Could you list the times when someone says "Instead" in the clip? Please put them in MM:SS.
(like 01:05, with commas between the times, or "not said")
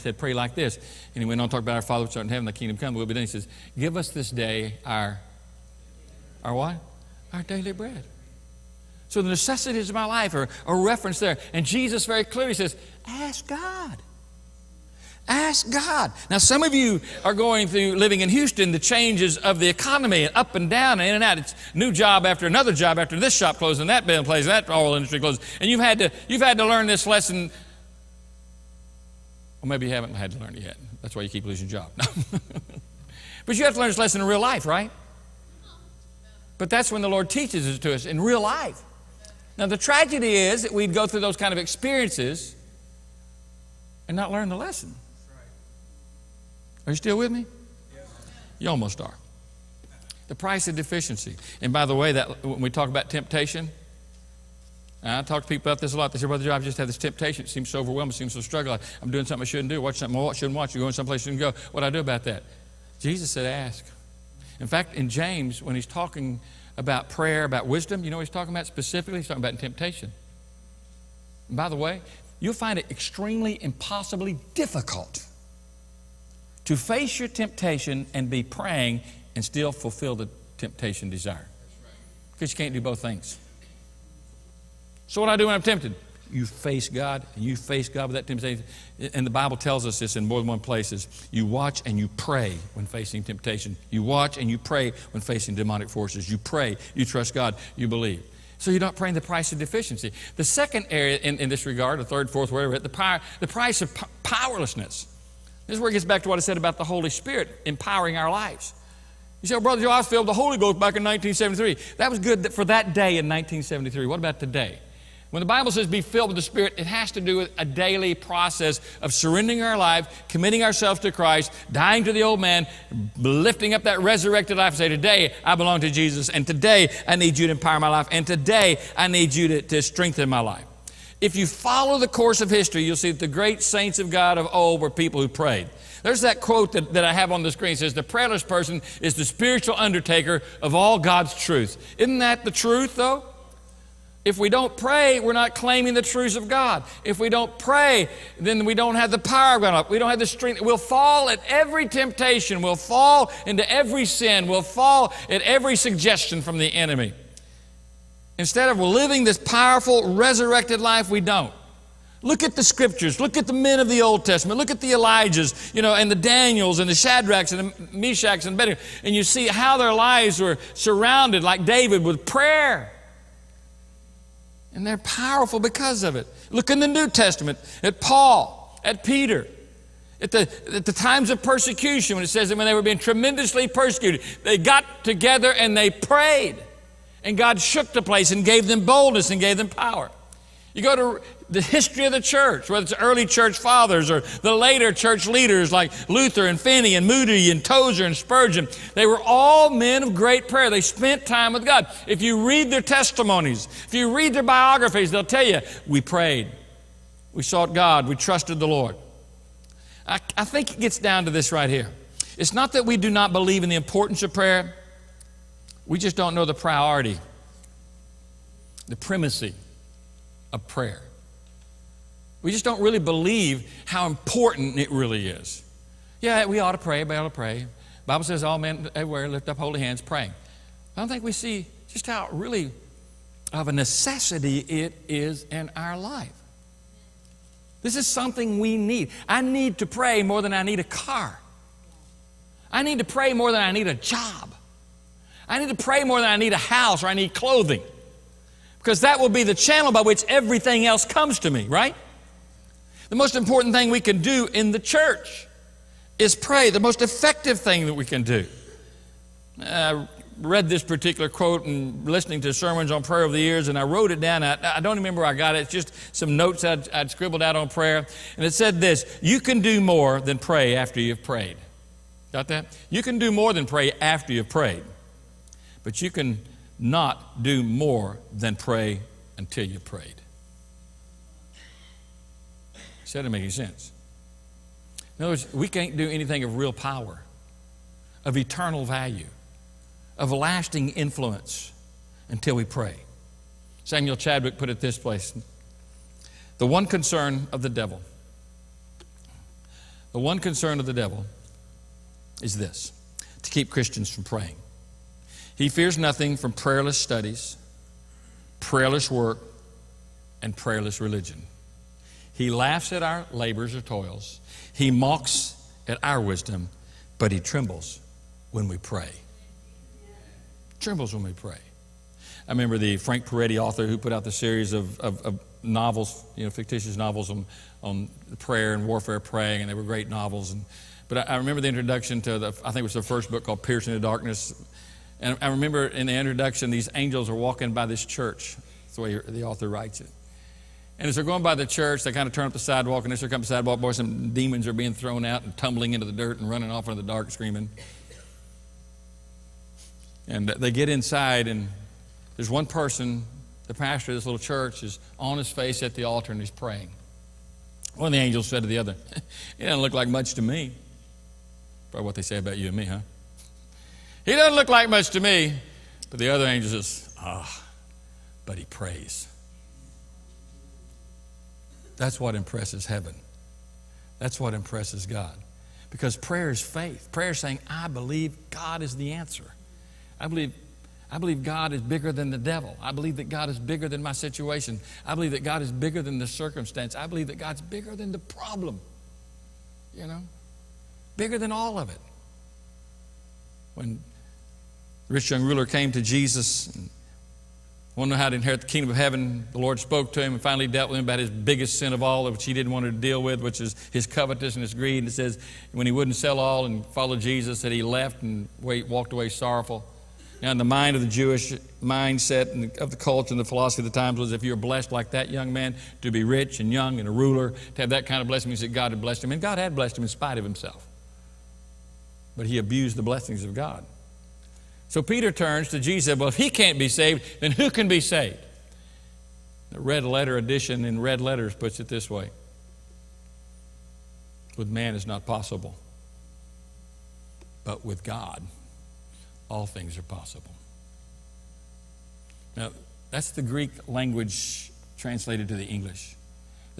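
02:38.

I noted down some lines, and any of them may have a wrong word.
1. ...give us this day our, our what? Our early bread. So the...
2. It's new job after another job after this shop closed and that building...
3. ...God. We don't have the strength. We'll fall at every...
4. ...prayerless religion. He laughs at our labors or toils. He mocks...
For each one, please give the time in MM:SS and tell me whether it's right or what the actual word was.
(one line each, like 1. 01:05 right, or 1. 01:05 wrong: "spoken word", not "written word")
1. 00:03 wrong: "daily", not "early"
2. 00:21 right
3. 02:29 right
4. 05:10 right.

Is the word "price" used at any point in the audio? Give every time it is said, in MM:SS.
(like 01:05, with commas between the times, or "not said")
00:50, 01:39, 01:43.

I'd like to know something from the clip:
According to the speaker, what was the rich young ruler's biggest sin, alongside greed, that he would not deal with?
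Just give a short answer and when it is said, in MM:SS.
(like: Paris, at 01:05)
Covetousness, at 06:44.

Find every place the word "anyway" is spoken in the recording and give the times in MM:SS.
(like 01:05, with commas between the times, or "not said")
not said.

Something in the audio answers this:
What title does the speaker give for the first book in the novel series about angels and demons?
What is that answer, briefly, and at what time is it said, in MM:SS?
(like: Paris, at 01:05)
Piercing the Darkness, at 05:33.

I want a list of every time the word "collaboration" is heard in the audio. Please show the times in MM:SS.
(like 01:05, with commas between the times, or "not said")
not said.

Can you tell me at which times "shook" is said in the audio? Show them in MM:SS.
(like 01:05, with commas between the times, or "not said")
03:07.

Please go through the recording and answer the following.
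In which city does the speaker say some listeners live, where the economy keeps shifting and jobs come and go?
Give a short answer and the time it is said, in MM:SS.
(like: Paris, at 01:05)
Houston, at 00:18.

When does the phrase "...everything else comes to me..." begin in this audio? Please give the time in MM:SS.
04:10.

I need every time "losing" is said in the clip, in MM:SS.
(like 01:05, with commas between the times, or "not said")
00:31.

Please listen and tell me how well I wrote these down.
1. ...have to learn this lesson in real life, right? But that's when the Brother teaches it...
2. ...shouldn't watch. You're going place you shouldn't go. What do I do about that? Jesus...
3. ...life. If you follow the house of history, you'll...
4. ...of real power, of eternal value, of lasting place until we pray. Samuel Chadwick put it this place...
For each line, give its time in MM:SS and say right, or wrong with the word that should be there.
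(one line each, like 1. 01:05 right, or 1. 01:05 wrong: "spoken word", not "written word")
1. 00:33 wrong: "Lord", not "Brother"
2. 01:00 wrong: "someplace", not "place"
3. 02:10 wrong: "course", not "house"
4. 04:46 wrong: "influence", not "place".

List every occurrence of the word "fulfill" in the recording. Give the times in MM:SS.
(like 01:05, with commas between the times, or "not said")
01:19.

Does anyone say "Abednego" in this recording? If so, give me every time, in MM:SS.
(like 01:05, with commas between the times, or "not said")
02:48.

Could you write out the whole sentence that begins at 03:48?
Bible says all men everywhere lift up holy hands praying.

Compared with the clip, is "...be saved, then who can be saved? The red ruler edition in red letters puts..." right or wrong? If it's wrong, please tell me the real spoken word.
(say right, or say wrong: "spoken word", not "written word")
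wrong: "letter", not "ruler".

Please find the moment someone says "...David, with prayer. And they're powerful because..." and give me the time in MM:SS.
02:51.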